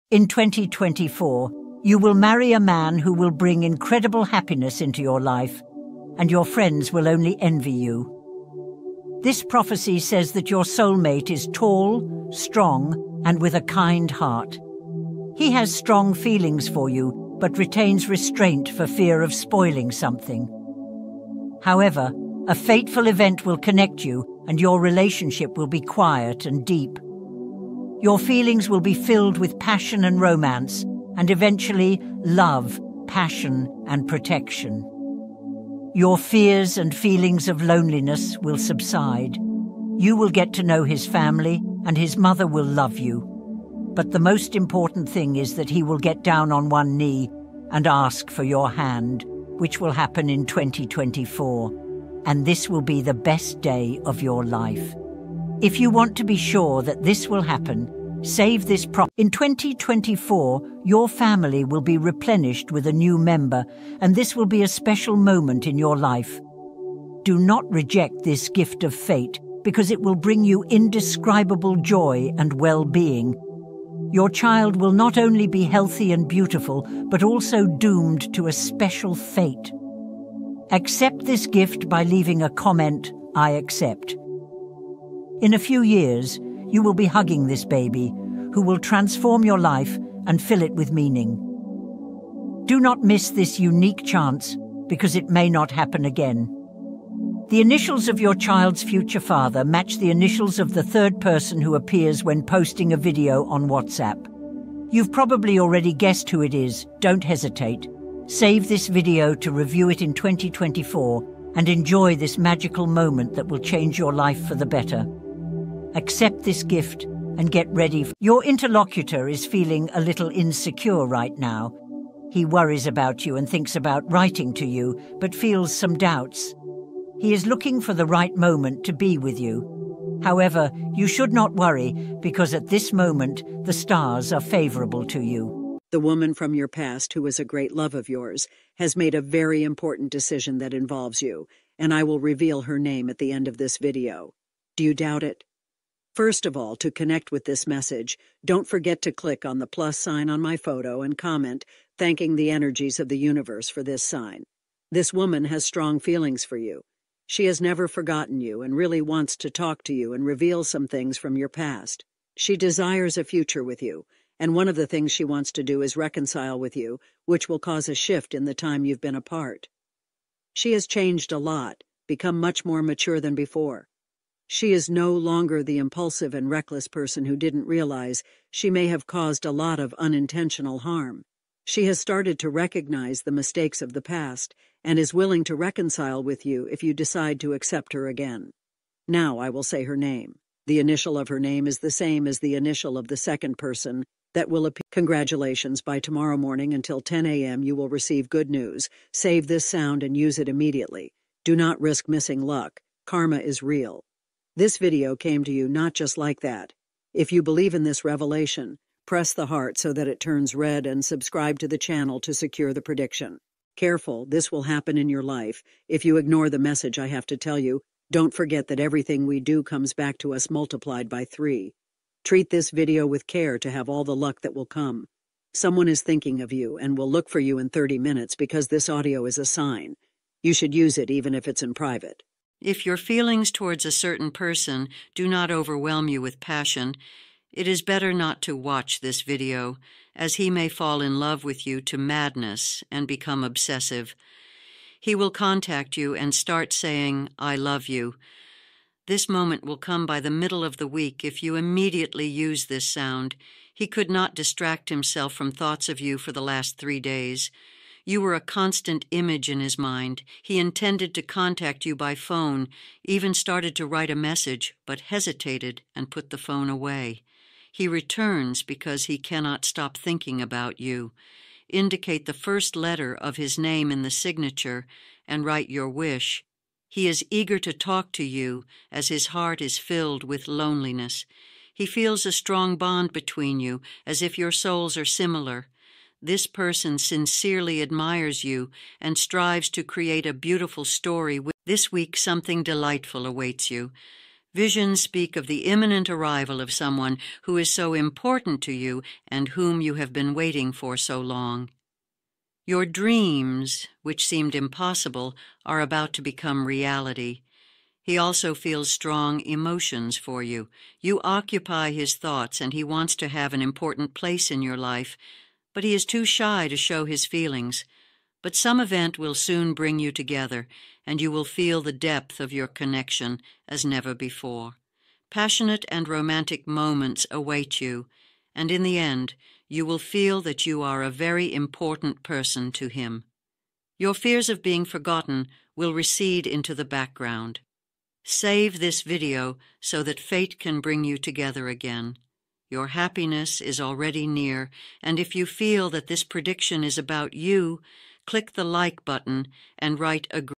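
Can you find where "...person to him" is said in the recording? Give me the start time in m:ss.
5:32.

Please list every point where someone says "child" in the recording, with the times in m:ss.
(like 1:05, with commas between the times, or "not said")
1:14, 1:38.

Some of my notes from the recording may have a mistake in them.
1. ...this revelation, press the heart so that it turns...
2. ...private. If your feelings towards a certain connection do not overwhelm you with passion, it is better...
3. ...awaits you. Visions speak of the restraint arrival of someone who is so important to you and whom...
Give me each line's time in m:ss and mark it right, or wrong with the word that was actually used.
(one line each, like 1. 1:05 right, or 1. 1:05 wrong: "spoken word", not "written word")
1. 3:27 right
2. 3:51 wrong: "person", not "connection"
3. 4:53 wrong: "imminent", not "restraint".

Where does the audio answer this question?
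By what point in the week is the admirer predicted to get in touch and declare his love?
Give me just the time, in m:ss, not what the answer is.
4:10.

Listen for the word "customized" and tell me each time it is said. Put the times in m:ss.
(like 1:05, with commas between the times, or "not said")
not said.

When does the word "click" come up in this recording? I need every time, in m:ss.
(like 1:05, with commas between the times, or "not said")
2:29, 5:48.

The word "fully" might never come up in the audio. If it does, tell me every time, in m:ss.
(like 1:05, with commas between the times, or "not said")
not said.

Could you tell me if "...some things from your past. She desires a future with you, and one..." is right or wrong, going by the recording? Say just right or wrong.
right.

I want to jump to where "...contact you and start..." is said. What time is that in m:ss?
4:05.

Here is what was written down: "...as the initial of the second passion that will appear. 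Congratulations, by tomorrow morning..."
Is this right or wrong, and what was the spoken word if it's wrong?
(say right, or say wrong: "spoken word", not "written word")
wrong: "person", not "passion".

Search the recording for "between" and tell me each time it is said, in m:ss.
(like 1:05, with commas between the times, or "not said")
4:43.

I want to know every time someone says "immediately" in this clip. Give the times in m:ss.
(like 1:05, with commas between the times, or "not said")
3:20, 4:11.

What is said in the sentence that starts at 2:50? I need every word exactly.
She has changed a lot, become much more mature than before.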